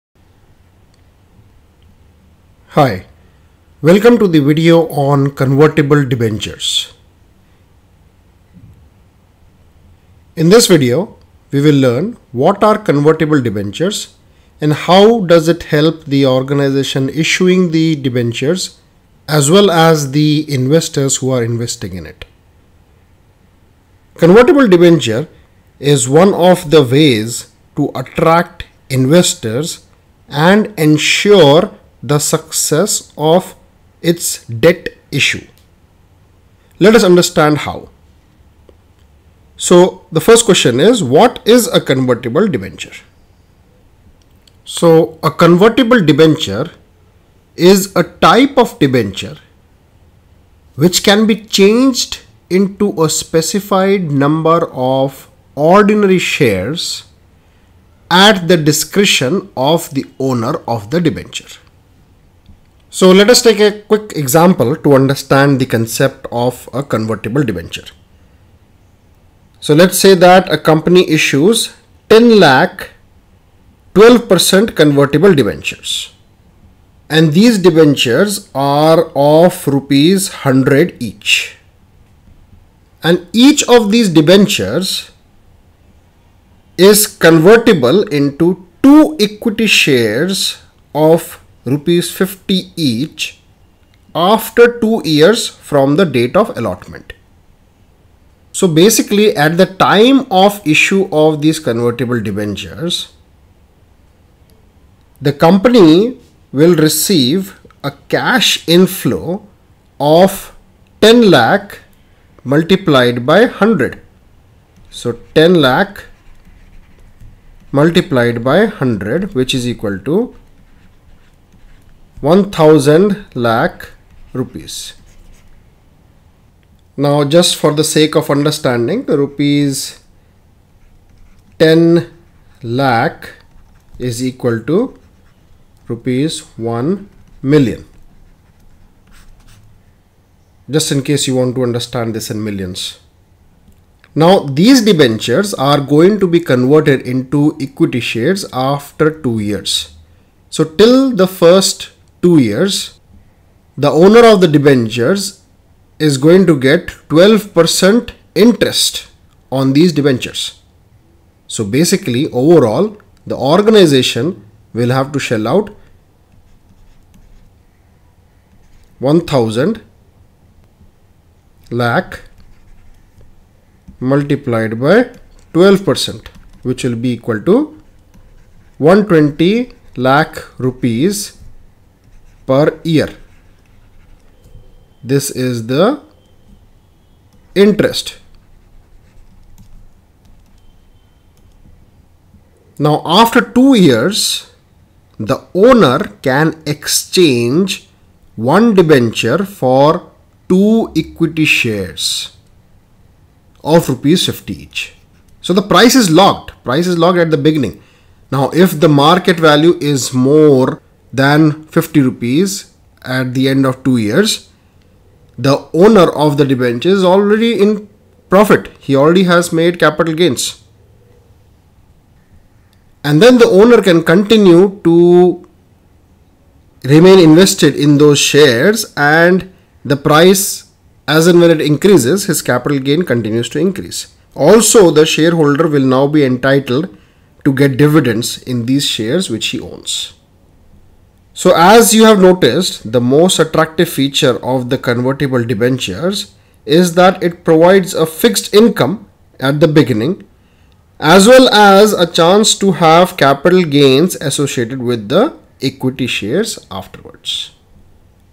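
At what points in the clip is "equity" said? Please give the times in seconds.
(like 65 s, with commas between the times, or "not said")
89 s, 147 s, 201 s, 255 s.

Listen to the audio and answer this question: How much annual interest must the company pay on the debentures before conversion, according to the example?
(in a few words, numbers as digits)
120 lakh rupees.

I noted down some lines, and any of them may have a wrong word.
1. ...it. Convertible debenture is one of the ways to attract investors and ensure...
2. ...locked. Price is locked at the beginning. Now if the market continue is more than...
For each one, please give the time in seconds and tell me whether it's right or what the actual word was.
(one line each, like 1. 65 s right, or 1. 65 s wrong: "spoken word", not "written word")
1. 22 s right
2. 206 s wrong: "value", not "continue".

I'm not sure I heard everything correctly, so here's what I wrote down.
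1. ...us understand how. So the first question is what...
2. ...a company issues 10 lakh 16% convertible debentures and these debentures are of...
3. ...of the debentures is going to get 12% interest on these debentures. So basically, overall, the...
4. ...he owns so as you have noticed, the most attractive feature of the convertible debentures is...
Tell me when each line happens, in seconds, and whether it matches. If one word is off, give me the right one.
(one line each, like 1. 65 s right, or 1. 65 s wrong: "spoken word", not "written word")
1. 36 s right
2. 70 s wrong: "12", not "16"
3. 154 s right
4. 239 s right.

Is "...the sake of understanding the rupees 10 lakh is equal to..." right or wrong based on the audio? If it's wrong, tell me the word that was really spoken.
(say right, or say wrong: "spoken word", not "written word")
right.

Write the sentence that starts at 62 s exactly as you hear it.
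So let us take a quick example to understand the concept of a convertible debenture.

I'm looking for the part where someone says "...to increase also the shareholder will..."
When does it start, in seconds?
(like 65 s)
233 s.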